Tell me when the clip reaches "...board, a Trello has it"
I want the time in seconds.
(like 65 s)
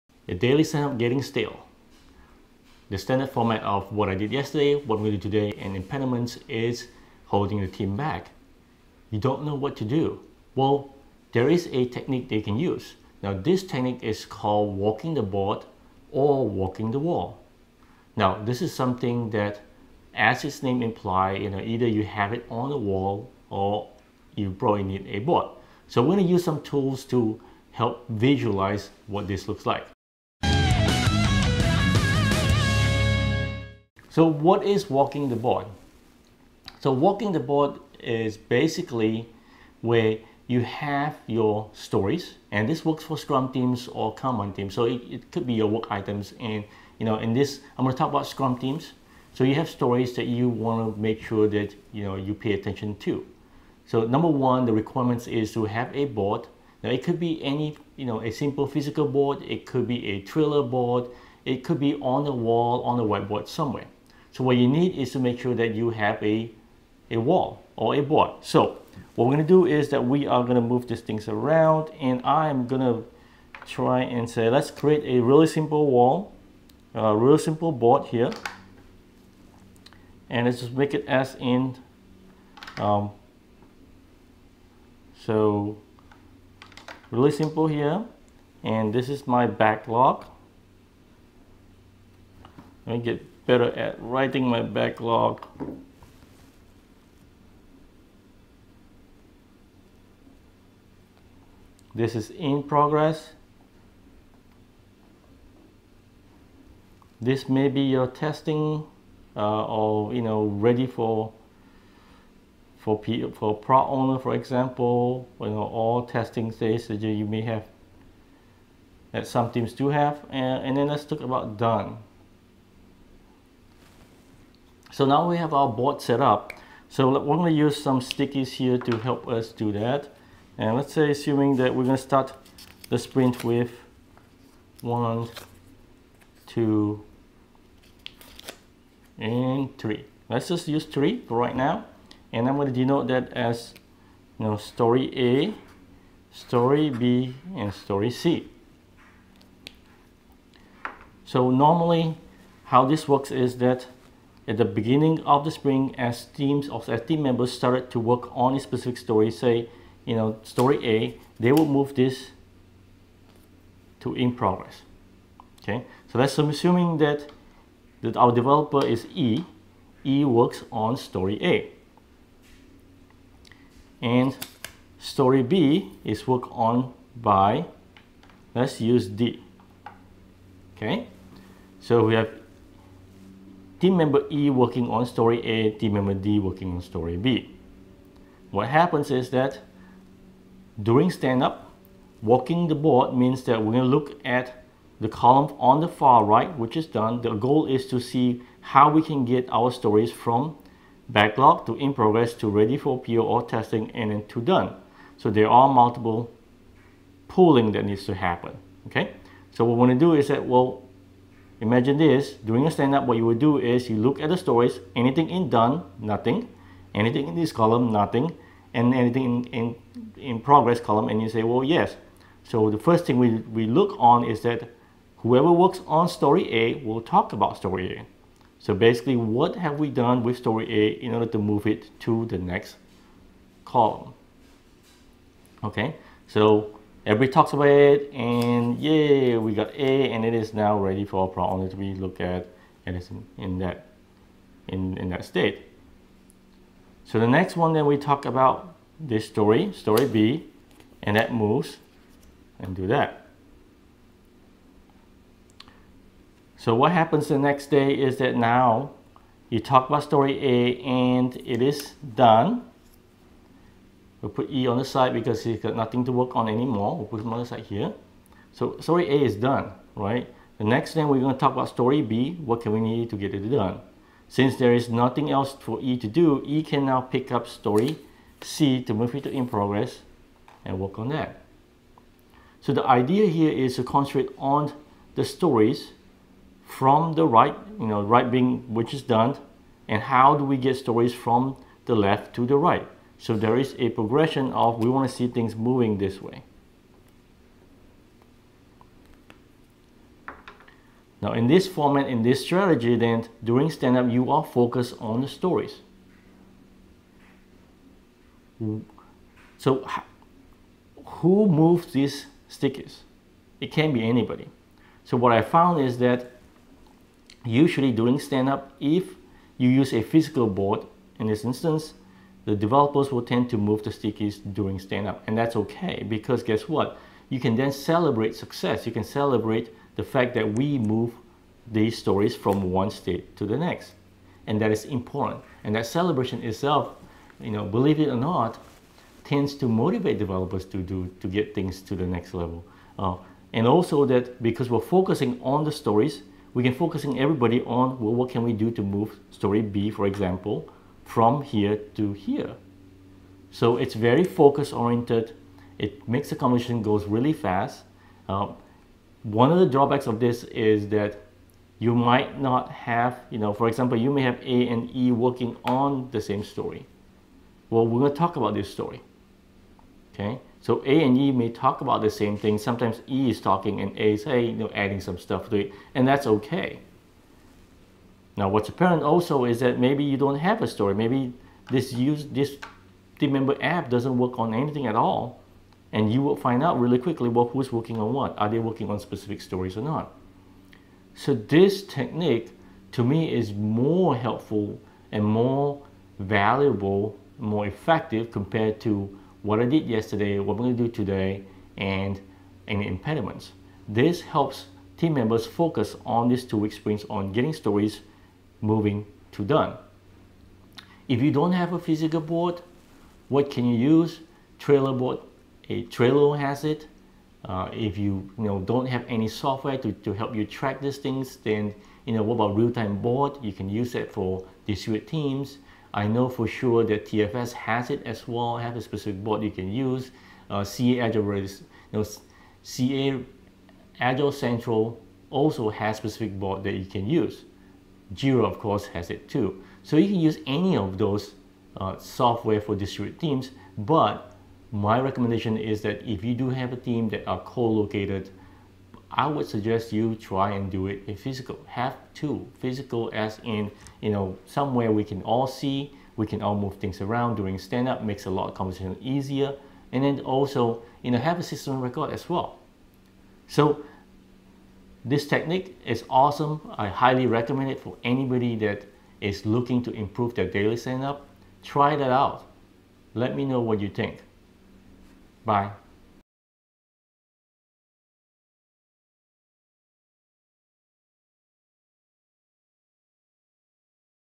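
414 s.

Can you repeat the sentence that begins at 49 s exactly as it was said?
So you have stories that you want to make sure that you know you pay attention to.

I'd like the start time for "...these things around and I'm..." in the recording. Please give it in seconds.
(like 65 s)
70 s.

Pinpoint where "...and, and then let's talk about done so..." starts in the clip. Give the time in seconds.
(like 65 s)
120 s.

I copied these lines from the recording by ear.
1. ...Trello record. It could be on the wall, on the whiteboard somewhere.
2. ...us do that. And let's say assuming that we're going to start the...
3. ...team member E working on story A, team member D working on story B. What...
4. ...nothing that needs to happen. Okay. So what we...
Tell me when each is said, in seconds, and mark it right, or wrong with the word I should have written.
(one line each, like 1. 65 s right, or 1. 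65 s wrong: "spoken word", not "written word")
1. 60 s wrong: "board", not "record"
2. 129 s right
3. 183 s right
4. 207 s wrong: "pooling", not "nothing".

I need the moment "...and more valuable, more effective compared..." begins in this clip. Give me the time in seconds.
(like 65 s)
395 s.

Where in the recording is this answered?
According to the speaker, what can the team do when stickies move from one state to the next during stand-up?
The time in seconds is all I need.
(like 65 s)
327 s.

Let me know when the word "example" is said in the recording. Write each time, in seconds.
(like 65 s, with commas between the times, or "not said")
114 s, 350 s, 363 s.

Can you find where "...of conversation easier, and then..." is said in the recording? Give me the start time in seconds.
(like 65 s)
458 s.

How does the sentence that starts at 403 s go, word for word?
This helps team members focus on these two-week sprints on getting stories moving to done.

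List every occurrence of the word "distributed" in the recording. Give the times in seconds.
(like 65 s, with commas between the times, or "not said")
424 s, 442 s.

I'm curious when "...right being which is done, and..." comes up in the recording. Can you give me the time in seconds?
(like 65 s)
288 s.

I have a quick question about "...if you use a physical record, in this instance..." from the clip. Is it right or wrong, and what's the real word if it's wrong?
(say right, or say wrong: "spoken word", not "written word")
wrong: "board", not "record".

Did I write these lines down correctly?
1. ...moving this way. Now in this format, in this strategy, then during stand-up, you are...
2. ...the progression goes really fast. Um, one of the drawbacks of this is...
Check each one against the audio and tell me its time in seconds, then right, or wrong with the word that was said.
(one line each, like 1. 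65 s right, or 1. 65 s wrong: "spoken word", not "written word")
1. 295 s right
2. 356 s wrong: "conversation", not "progression".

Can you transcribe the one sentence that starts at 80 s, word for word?
And let's just make it as in, um, so really simple here.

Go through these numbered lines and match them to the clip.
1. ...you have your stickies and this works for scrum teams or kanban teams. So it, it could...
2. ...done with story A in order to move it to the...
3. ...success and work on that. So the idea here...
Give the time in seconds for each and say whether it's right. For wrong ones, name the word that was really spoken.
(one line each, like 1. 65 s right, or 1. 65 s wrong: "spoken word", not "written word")
1. 40 s wrong: "stories", not "stickies"
2. 229 s right
3. 279 s wrong: "progress", not "success".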